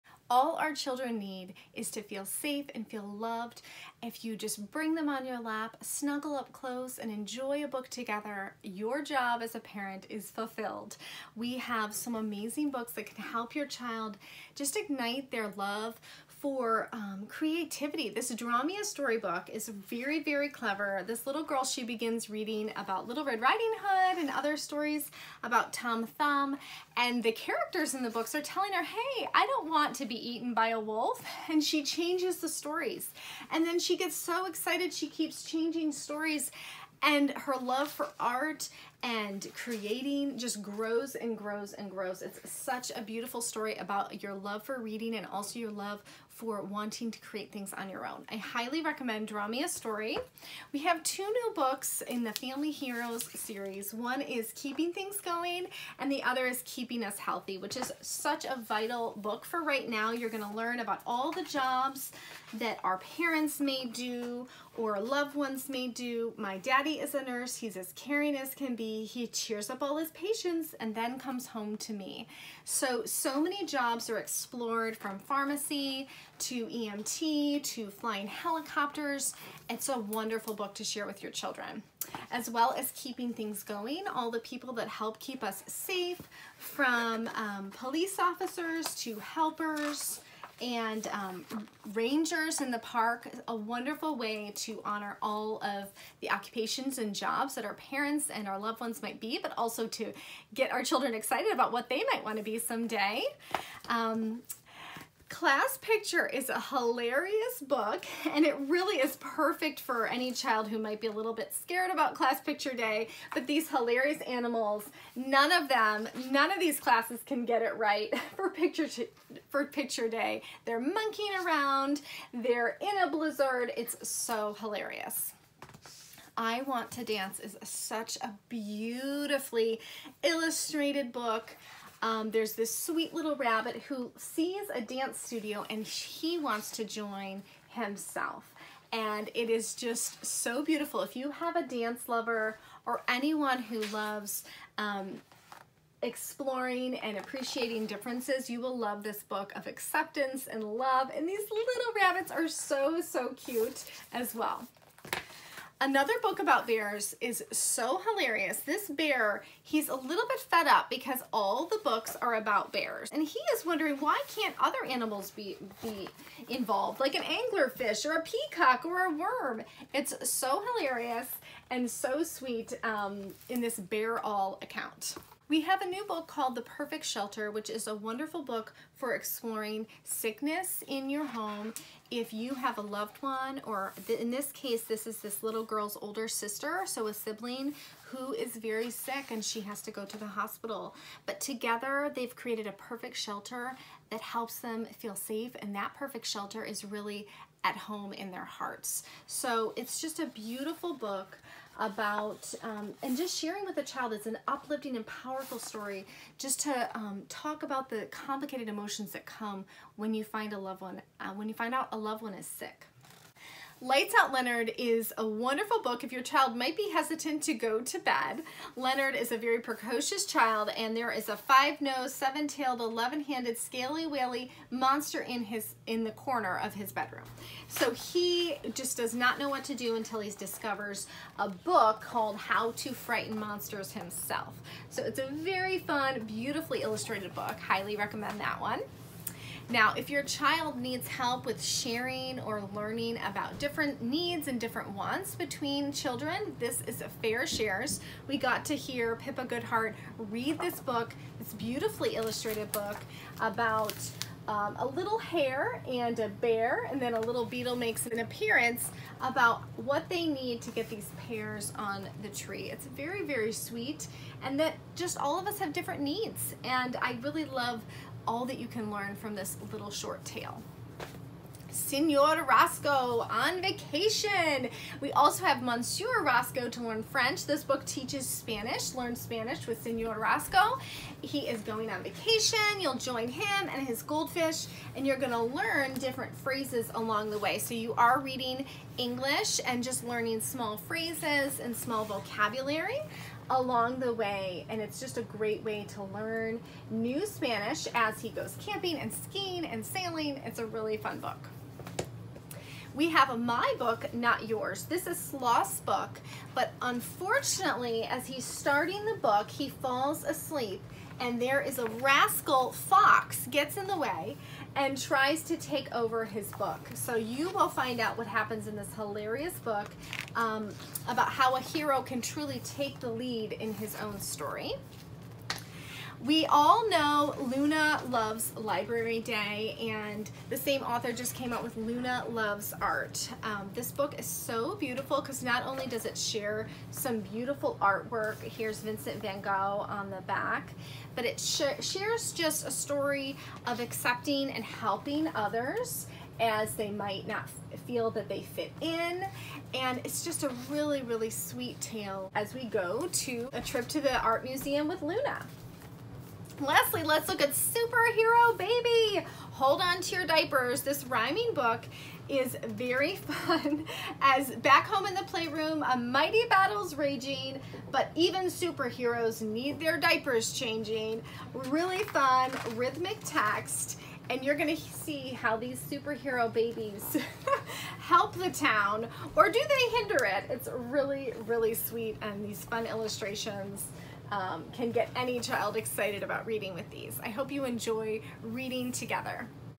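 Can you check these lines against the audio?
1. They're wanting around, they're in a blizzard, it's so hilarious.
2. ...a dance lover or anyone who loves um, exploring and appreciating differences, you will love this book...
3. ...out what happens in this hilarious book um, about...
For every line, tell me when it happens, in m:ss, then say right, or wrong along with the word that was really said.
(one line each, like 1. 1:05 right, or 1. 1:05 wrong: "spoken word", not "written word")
1. 2:00 wrong: "monkeying", not "wanting"
2. 2:21 right
3. 5:17 right.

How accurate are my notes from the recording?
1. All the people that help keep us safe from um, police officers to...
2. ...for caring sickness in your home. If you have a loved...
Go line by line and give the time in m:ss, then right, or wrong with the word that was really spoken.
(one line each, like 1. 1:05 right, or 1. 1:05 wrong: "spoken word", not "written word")
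1. 1:24 right
2. 2:58 wrong: "exploring", not "caring".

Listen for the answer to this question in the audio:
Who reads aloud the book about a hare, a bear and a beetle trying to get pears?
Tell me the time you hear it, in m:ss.
4:09.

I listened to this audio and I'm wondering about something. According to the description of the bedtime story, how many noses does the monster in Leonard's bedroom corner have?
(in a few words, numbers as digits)
5.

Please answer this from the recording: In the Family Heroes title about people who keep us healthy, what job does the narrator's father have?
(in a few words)
Nurse.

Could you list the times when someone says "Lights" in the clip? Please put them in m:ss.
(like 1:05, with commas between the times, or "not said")
3:33.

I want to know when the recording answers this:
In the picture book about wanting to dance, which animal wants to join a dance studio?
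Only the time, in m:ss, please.
2:13.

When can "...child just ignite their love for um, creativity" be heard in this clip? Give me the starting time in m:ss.
0:13.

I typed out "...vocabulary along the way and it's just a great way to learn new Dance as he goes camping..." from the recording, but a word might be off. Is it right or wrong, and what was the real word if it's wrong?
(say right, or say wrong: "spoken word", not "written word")
wrong: "Spanish", not "Dance".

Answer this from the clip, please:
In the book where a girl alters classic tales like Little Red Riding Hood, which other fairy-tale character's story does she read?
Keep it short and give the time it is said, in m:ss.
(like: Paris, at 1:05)
Tom Thumb, at 0:25.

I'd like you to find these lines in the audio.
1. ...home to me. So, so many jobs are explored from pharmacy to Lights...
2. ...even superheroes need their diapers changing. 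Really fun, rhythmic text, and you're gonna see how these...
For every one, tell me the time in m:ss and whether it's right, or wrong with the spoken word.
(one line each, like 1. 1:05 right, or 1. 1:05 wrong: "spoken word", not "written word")
1. 1:11 wrong: "EMT", not "Lights"
2. 6:08 right.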